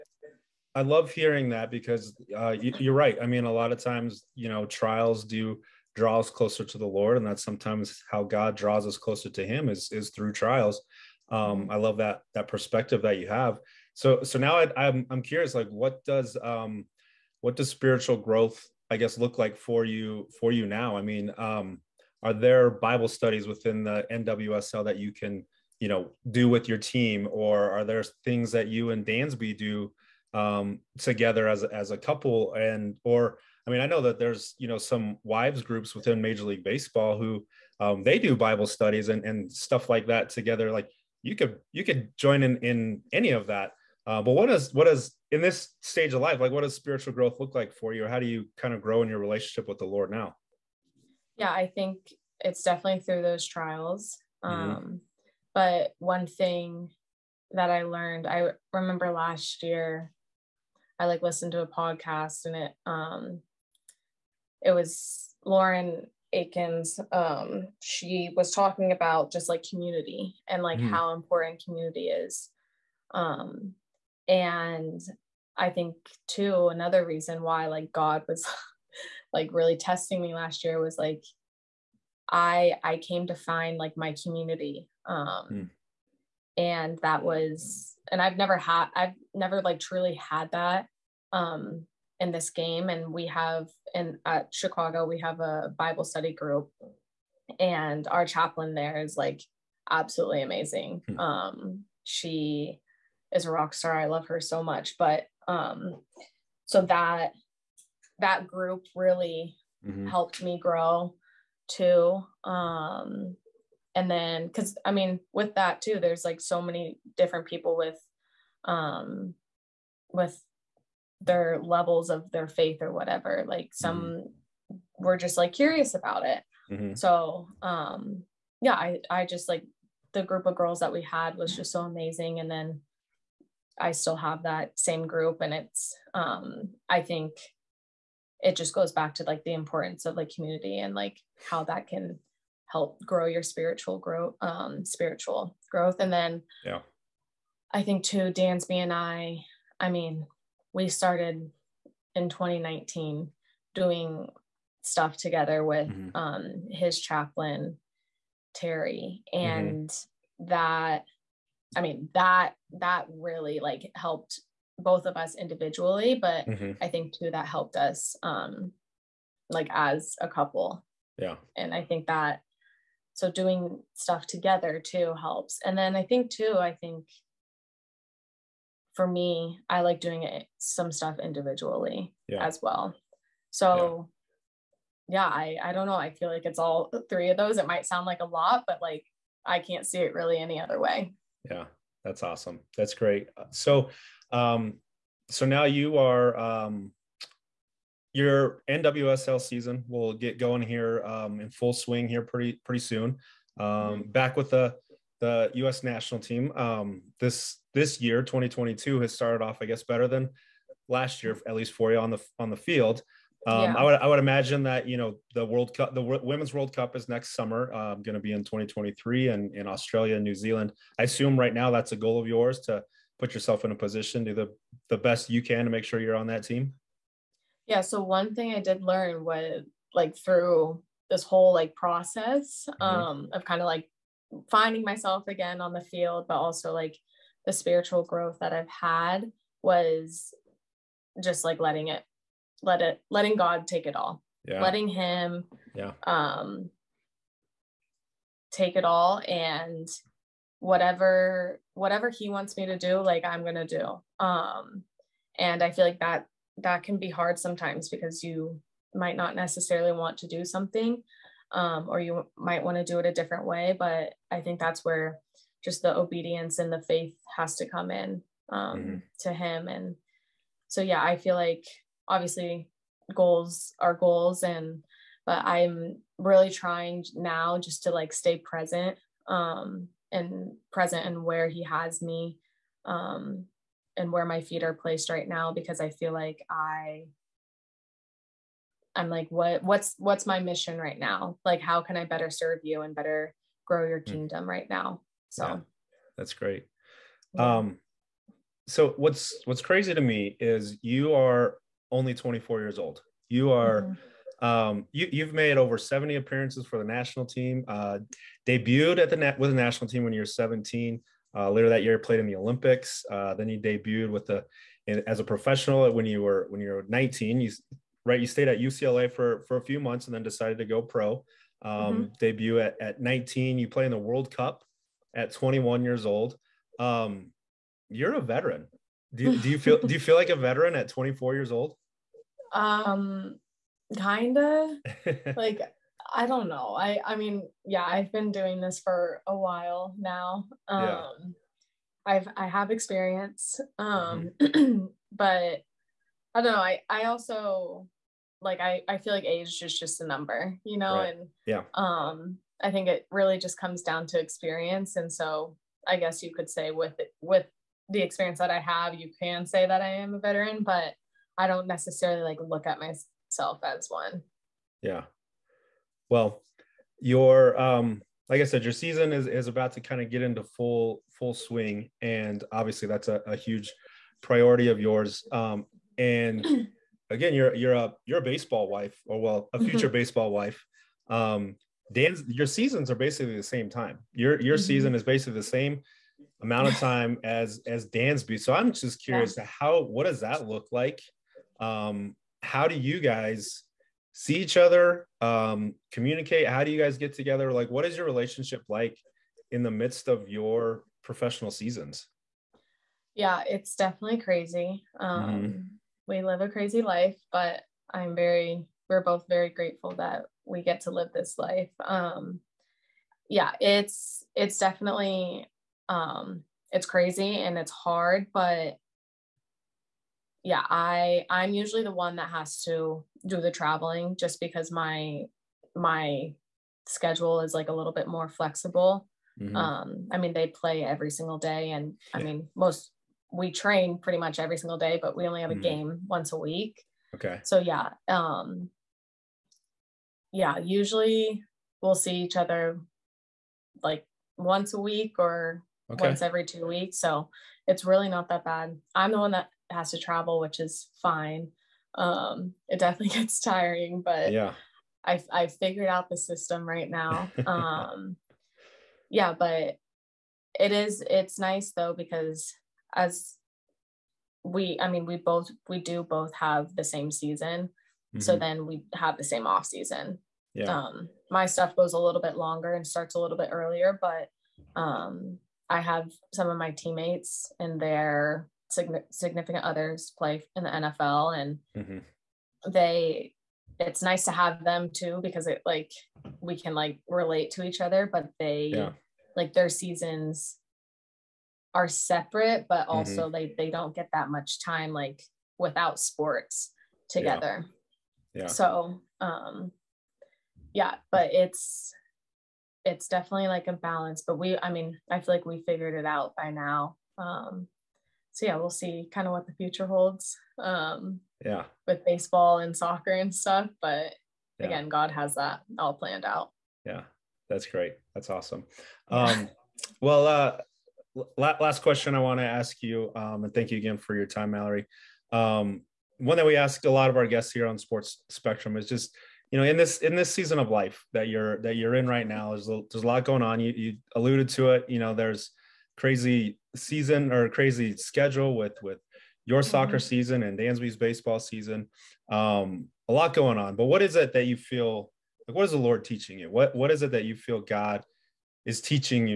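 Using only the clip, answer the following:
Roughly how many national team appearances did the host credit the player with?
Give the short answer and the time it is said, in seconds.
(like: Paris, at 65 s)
over 70, at 305 s.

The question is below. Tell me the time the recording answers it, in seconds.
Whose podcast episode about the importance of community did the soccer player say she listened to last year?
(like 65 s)
65 s.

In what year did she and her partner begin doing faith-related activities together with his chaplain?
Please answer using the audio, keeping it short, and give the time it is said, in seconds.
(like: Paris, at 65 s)
2019, at 152 s.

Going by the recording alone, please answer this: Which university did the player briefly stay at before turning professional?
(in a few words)
UCLA.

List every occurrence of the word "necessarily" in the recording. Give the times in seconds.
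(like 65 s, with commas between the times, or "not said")
259 s, 361 s.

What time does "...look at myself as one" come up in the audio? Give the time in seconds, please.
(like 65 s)
362 s.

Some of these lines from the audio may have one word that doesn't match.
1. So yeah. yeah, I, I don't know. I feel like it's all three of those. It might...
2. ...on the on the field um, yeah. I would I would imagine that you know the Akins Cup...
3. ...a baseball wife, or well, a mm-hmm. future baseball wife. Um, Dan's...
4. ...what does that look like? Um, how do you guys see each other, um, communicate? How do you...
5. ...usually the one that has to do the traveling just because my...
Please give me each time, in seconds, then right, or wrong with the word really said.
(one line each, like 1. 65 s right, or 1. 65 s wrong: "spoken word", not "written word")
1. 183 s right
2. 211 s wrong: "World", not "Akins"
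3. 378 s right
4. 389 s right
5. 421 s right.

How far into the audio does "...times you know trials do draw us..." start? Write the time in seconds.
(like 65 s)
3 s.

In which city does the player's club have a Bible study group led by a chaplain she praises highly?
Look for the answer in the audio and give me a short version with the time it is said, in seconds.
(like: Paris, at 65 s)
Chicago, at 94 s.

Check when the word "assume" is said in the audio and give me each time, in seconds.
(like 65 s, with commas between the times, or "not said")
221 s.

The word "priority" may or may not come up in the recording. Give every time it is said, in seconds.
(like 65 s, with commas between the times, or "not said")
374 s.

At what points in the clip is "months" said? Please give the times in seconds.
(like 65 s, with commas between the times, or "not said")
319 s.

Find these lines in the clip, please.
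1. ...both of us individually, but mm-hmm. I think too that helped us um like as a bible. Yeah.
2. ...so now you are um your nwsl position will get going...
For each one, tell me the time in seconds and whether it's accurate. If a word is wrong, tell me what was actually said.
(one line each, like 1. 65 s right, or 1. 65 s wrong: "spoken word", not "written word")
1. 164 s wrong: "couple", not "bible"
2. 195 s wrong: "season", not "position".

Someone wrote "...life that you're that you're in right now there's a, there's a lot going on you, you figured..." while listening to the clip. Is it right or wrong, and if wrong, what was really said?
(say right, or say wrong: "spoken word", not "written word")
wrong: "alluded", not "figured".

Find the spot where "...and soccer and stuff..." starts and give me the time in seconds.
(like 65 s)
512 s.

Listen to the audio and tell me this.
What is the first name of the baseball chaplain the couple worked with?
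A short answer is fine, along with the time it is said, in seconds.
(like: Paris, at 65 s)
Terry, at 158 s.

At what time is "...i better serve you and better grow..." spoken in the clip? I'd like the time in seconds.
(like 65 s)
291 s.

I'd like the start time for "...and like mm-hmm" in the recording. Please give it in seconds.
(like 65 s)
70 s.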